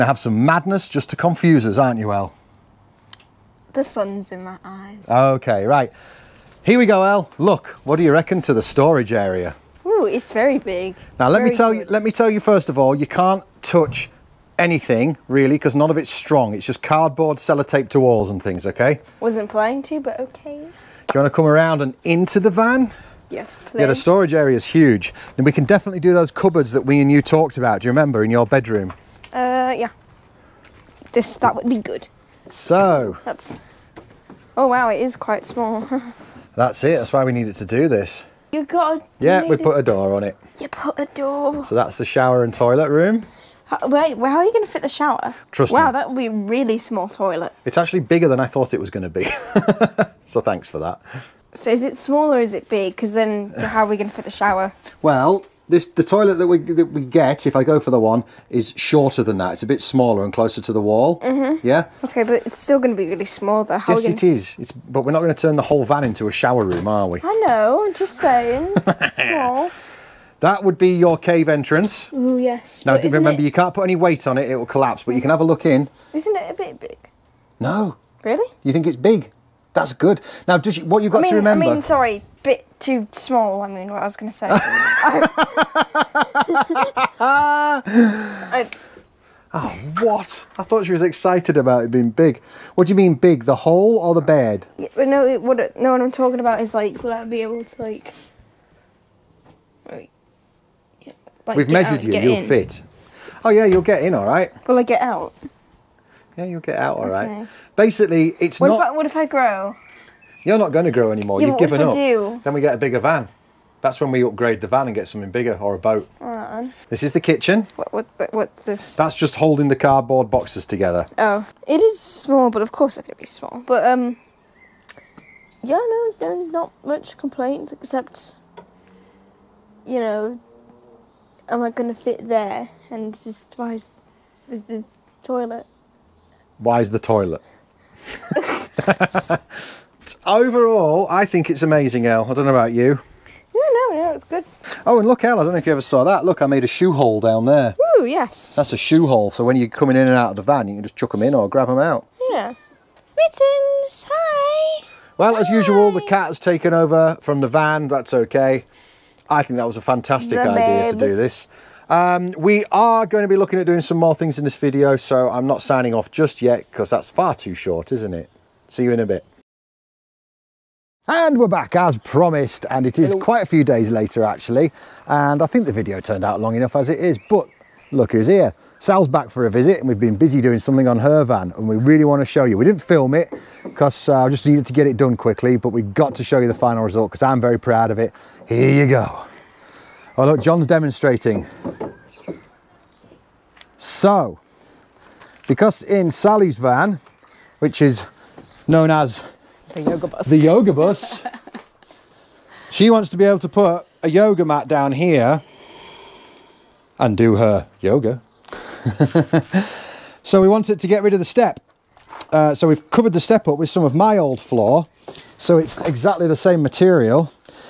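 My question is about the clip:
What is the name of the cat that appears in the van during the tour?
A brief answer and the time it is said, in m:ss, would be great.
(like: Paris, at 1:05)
Mittens, at 2:33.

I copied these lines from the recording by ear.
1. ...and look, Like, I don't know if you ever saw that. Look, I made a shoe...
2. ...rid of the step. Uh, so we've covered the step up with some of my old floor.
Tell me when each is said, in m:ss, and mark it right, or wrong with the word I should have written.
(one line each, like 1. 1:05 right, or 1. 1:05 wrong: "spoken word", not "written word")
1. 2:24 wrong: "Elle", not "Like"
2. 3:31 right.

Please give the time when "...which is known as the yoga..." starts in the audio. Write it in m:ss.
3:17.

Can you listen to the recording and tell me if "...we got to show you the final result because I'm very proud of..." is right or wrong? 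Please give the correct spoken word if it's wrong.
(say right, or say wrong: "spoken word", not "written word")
right.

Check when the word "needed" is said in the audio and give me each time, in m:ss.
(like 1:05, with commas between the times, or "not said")
0:37, 3:04.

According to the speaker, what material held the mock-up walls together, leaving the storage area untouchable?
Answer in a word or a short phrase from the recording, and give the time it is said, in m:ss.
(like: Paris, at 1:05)
Cardboard sellotape, at 0:16.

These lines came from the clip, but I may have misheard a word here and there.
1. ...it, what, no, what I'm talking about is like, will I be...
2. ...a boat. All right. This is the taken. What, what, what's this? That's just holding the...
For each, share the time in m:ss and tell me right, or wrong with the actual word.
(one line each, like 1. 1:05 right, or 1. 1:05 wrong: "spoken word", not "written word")
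1. 1:35 right
2. 1:55 wrong: "kitchen", not "taken".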